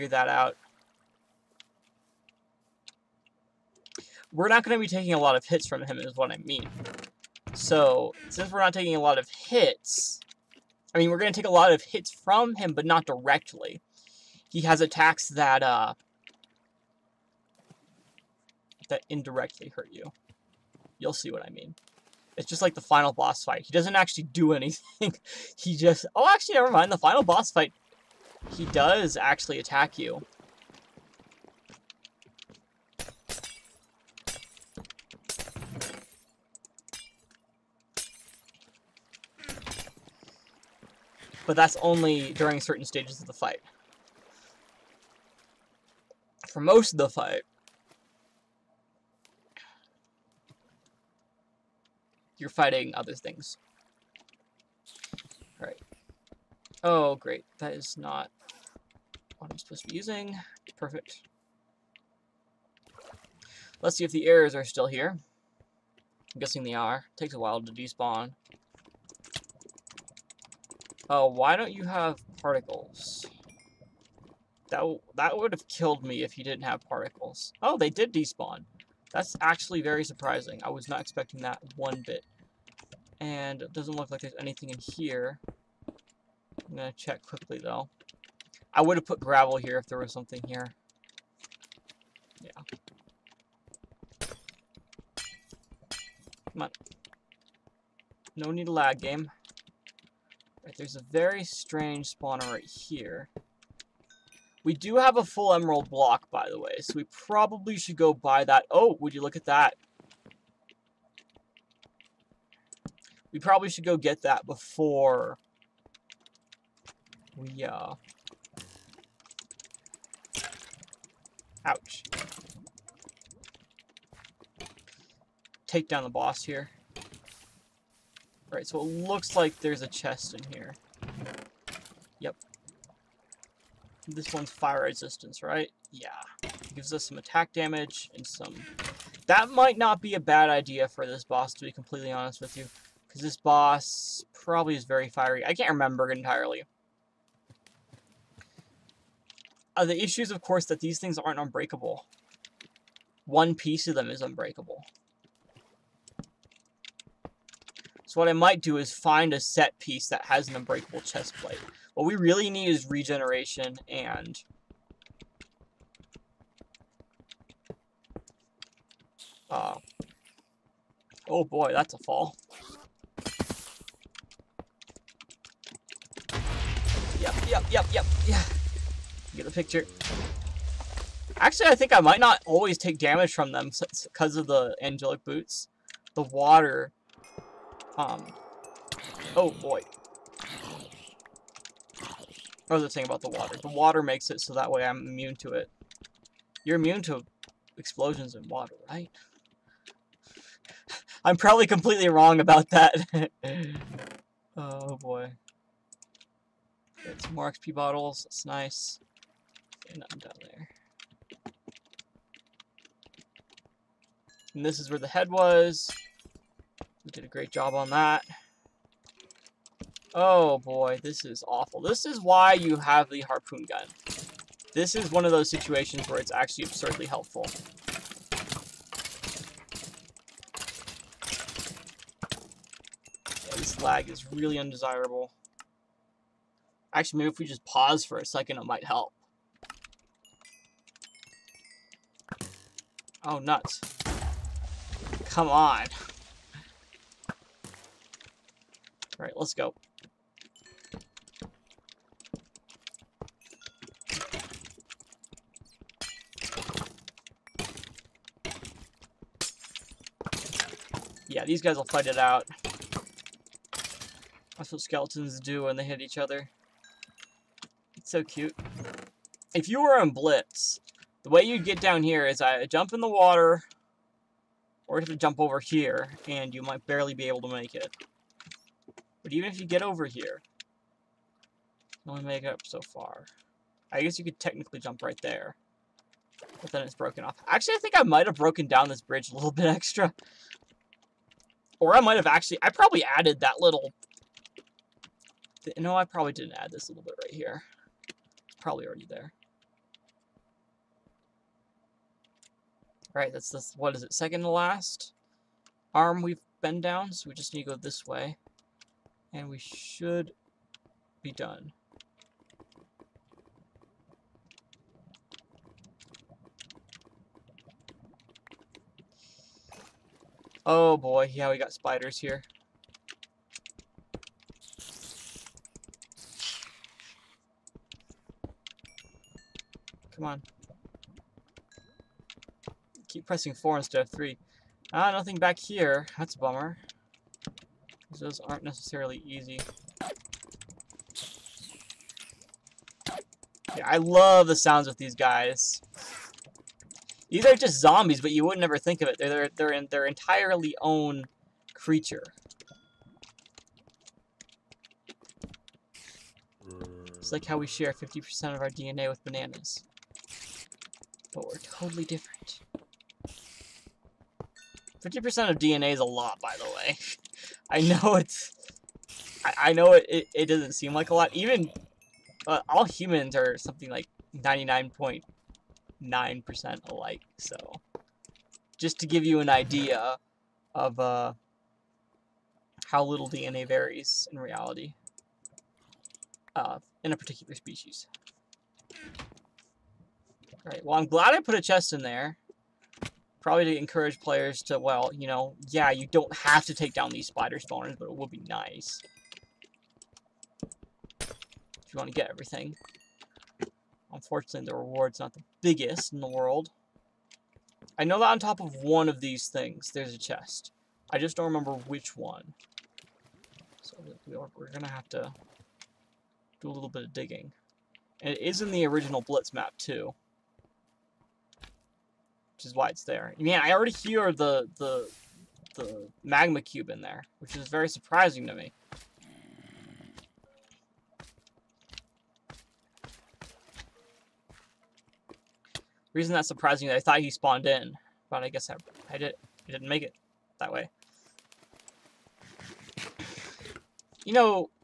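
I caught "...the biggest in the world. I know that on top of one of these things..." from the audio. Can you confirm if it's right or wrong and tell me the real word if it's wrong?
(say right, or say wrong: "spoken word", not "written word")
right.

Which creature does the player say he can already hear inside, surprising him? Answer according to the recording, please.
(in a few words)
Magma cube.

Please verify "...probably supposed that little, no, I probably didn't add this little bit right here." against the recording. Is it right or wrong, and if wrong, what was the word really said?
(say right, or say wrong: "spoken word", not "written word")
wrong: "added", not "supposed".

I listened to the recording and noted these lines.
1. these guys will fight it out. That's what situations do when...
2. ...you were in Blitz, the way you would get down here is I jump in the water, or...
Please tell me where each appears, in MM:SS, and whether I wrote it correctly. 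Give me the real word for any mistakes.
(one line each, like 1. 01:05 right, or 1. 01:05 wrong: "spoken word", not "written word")
1. 04:21 wrong: "skeletons", not "situations"
2. 04:29 right.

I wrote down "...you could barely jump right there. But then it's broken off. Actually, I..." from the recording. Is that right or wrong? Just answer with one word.
wrong.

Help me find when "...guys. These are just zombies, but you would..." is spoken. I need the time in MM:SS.
05:45.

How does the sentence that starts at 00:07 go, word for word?
So, since we're not taking a lot of hits...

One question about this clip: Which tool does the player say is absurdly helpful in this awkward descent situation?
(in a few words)
Harpoon gun.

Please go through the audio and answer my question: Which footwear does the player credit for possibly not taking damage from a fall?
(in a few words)
Angelic boots.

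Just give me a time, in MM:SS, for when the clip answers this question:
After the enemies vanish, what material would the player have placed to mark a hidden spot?
01:29.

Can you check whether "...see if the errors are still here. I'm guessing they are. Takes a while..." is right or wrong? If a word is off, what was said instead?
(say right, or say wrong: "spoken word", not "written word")
right.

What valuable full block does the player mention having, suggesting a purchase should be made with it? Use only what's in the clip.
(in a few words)
Emerald block.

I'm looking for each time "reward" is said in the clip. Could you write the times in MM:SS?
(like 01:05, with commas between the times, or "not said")
06:44.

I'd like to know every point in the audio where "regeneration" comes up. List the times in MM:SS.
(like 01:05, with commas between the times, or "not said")
02:42.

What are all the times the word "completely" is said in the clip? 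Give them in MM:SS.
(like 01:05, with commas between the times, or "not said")
02:21, 03:21.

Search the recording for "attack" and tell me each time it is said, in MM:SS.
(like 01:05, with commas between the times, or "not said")
00:14, 00:29, 02:17.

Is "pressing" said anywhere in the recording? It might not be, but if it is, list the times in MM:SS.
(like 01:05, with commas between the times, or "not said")
05:33.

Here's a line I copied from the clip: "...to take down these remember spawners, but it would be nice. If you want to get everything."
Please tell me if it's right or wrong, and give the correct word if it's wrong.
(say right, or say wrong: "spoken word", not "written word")
wrong: "spider", not "remember".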